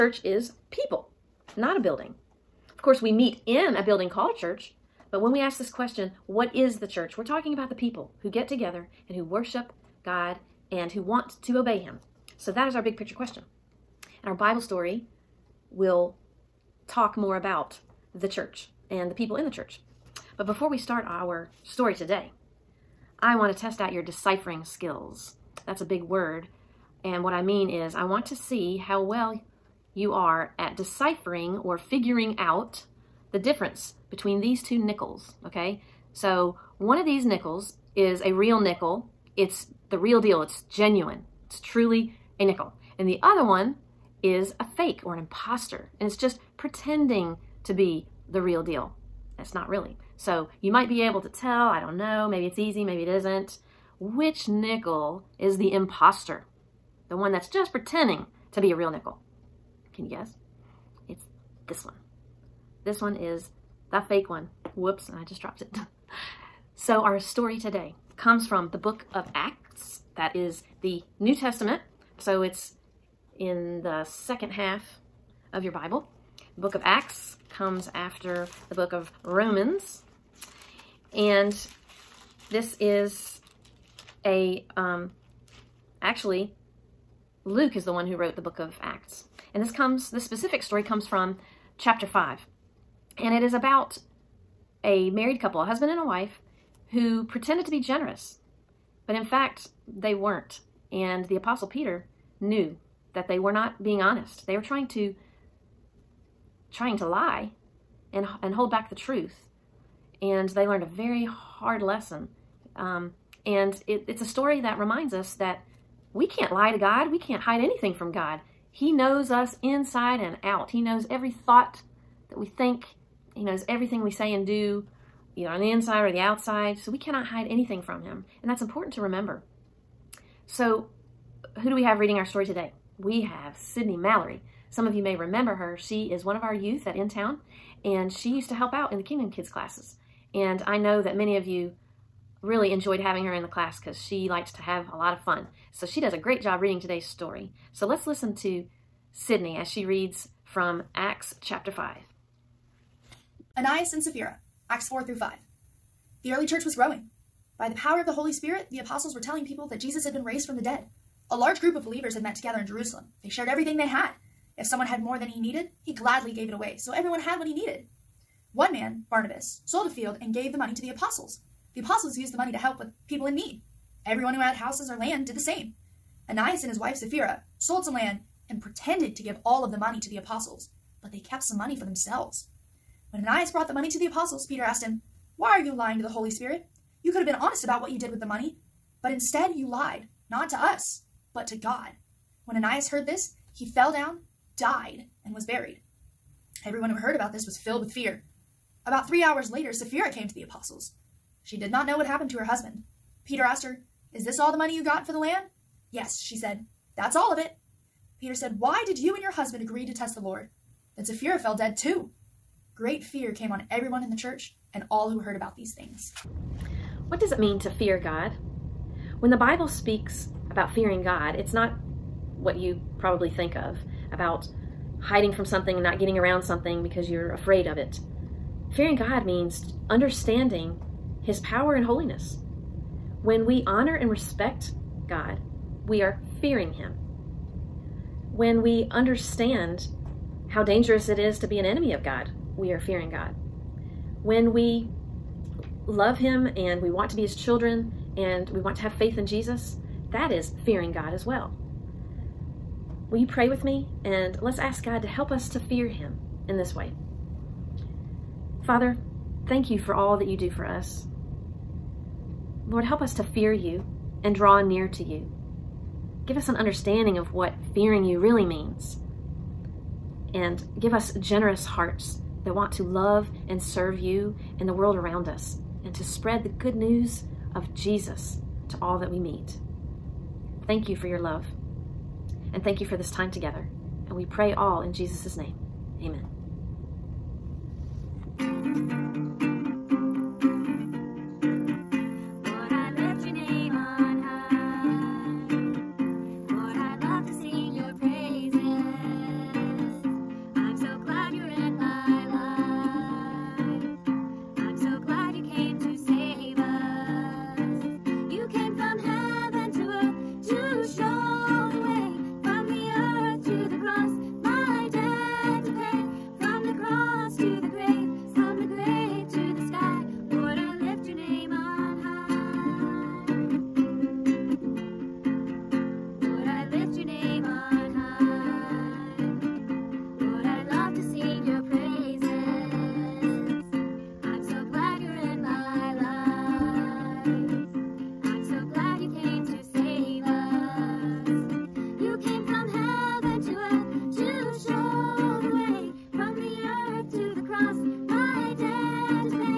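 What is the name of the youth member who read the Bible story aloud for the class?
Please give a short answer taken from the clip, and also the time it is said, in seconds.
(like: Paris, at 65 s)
Sydney Mallory, at 133 s.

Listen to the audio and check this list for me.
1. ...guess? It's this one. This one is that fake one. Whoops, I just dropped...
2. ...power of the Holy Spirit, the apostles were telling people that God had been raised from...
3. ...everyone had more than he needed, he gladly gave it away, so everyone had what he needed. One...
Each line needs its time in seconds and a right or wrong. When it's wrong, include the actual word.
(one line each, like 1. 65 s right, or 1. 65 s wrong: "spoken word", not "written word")
1. 60 s right
2. 157 s wrong: "Jesus", not "God"
3. 164 s wrong: "someone", not "everyone".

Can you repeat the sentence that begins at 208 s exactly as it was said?
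Peter said, Why did you and your husband agree to test the Lord?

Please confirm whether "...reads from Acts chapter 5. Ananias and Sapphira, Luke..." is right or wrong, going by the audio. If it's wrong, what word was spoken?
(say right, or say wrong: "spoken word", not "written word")
wrong: "Acts", not "Luke".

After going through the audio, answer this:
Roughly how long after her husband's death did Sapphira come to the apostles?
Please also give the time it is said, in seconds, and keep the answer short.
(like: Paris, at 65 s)
3 hours, at 199 s.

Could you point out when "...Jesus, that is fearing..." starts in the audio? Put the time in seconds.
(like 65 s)
249 s.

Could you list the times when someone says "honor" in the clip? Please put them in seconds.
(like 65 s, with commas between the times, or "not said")
233 s.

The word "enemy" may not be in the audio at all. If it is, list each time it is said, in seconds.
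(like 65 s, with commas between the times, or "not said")
241 s.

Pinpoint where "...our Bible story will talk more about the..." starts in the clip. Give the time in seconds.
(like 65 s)
14 s.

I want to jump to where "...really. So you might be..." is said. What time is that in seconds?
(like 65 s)
49 s.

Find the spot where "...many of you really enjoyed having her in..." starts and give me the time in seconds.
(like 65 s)
141 s.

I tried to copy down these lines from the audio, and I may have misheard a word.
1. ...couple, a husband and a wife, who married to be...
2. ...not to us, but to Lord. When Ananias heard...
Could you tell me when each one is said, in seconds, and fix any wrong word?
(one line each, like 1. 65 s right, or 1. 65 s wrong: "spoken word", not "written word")
1. 95 s wrong: "pretended", not "married"
2. 190 s wrong: "God", not "Lord".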